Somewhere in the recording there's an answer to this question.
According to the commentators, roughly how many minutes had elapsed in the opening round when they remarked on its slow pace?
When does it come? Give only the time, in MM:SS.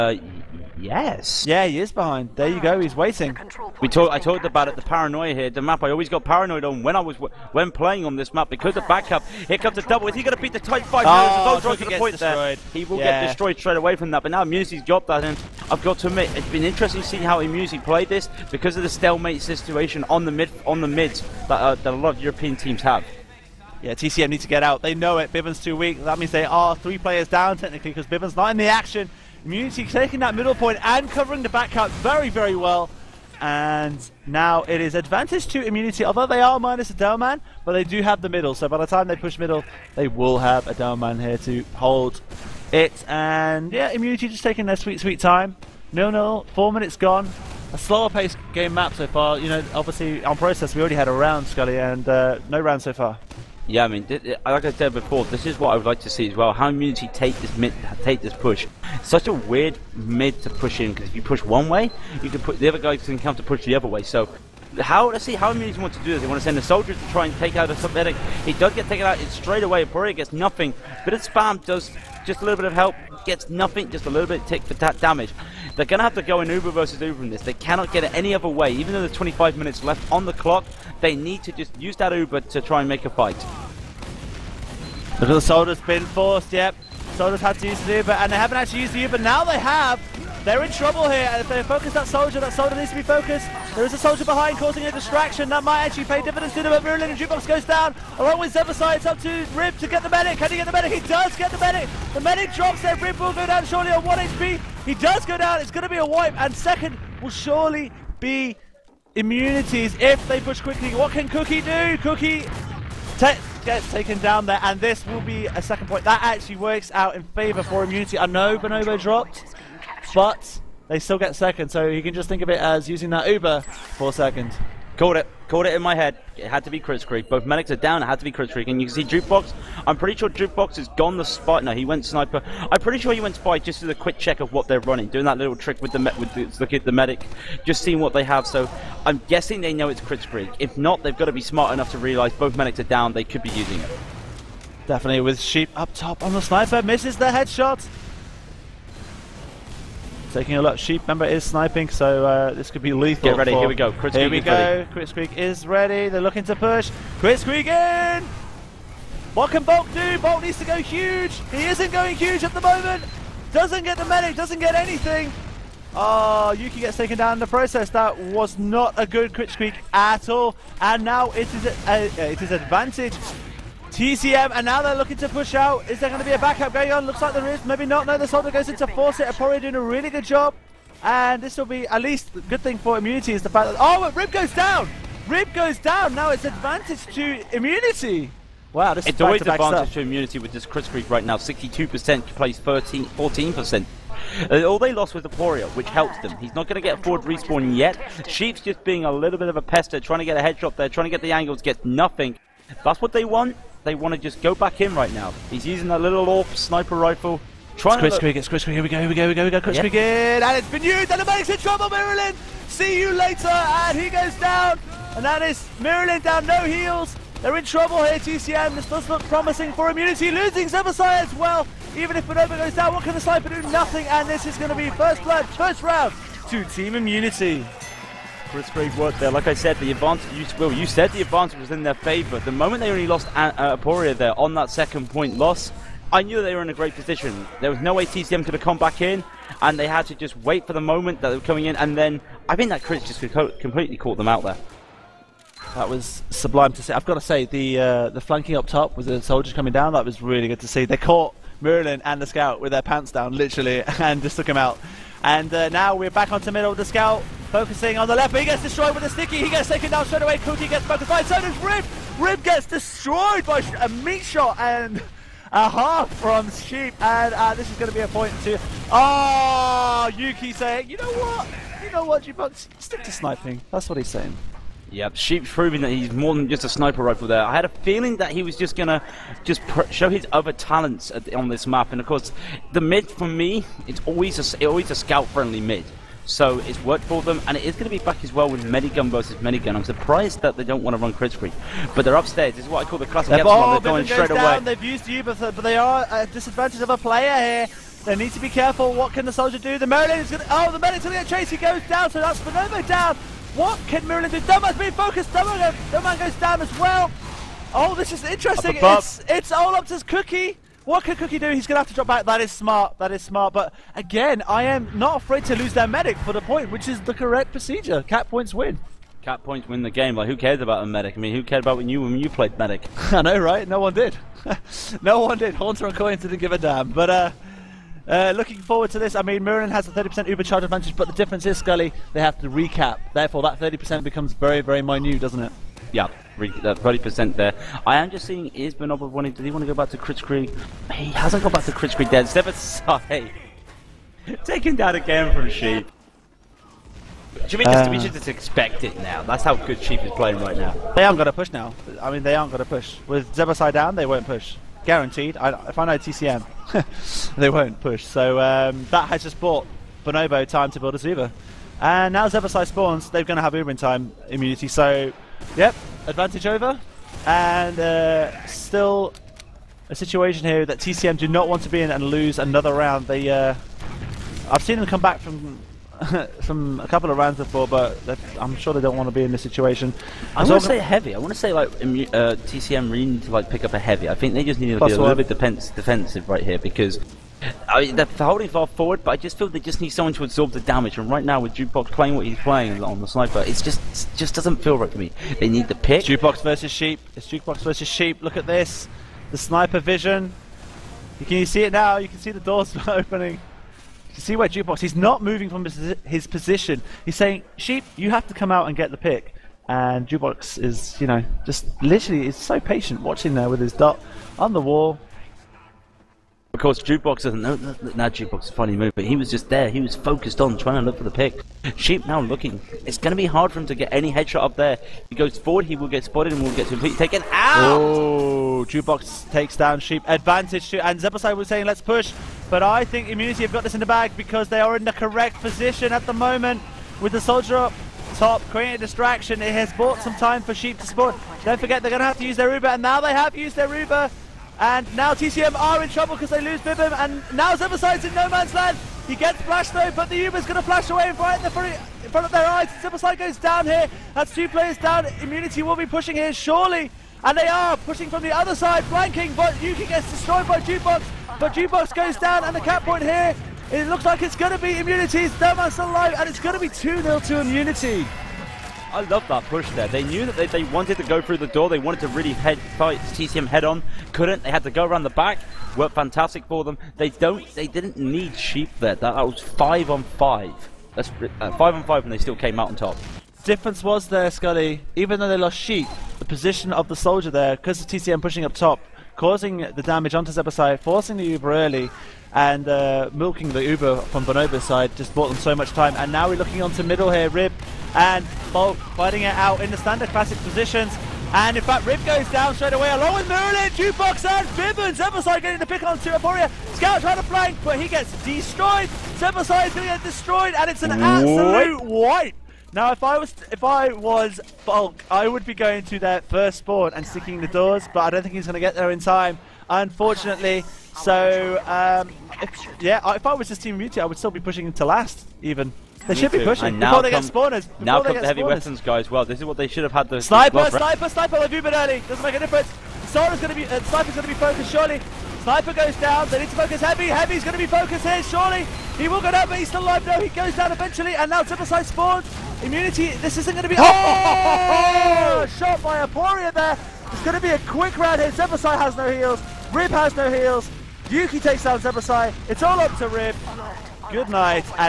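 00:46.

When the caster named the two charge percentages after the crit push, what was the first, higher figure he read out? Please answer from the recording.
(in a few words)
62%.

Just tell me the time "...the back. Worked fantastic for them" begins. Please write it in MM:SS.
07:55.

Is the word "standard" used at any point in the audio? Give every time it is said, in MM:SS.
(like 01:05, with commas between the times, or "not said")
08:19.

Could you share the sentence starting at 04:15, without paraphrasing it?
And uh, now we're back onto middle of the scout, focusing on the left, but he gets destroyed with a sticky.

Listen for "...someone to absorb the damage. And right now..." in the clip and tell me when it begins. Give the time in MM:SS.
06:29.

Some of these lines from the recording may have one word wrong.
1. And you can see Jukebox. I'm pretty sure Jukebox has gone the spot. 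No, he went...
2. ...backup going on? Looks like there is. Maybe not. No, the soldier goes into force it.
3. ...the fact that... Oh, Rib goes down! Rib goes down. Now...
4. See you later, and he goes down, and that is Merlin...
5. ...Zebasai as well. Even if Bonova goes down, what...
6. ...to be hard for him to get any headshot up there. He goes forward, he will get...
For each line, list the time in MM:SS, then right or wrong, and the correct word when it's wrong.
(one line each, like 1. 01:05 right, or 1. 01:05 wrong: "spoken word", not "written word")
1. 02:08 right
2. 02:56 right
3. 03:03 right
4. 03:32 right
5. 03:40 right
6. 07:03 right.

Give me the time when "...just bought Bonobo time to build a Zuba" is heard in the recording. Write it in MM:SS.
05:59.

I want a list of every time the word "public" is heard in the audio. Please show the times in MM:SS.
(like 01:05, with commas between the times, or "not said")
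not said.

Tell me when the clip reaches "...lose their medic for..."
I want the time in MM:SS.
05:15.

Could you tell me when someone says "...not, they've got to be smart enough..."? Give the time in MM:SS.
02:20.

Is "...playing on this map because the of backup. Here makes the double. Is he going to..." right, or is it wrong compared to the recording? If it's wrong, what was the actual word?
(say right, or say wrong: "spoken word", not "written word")
wrong: "comes", not "makes".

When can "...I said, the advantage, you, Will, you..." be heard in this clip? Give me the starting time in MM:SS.
03:49.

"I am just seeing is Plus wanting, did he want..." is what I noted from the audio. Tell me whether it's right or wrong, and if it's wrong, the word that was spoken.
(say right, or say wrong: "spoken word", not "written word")
wrong: "Bonobo", not "Plus".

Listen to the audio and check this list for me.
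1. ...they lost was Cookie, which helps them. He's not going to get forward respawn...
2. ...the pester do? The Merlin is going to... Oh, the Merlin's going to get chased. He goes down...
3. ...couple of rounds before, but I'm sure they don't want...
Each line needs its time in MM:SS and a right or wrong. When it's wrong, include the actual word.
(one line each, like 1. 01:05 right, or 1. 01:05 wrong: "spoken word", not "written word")
1. 03:14 wrong: "Aporia", not "Cookie"
2. 04:59 wrong: "soldier", not "pester"
3. 06:16 right.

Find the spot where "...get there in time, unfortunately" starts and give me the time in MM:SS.
08:38.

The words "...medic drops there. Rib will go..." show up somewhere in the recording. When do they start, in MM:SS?
01:42.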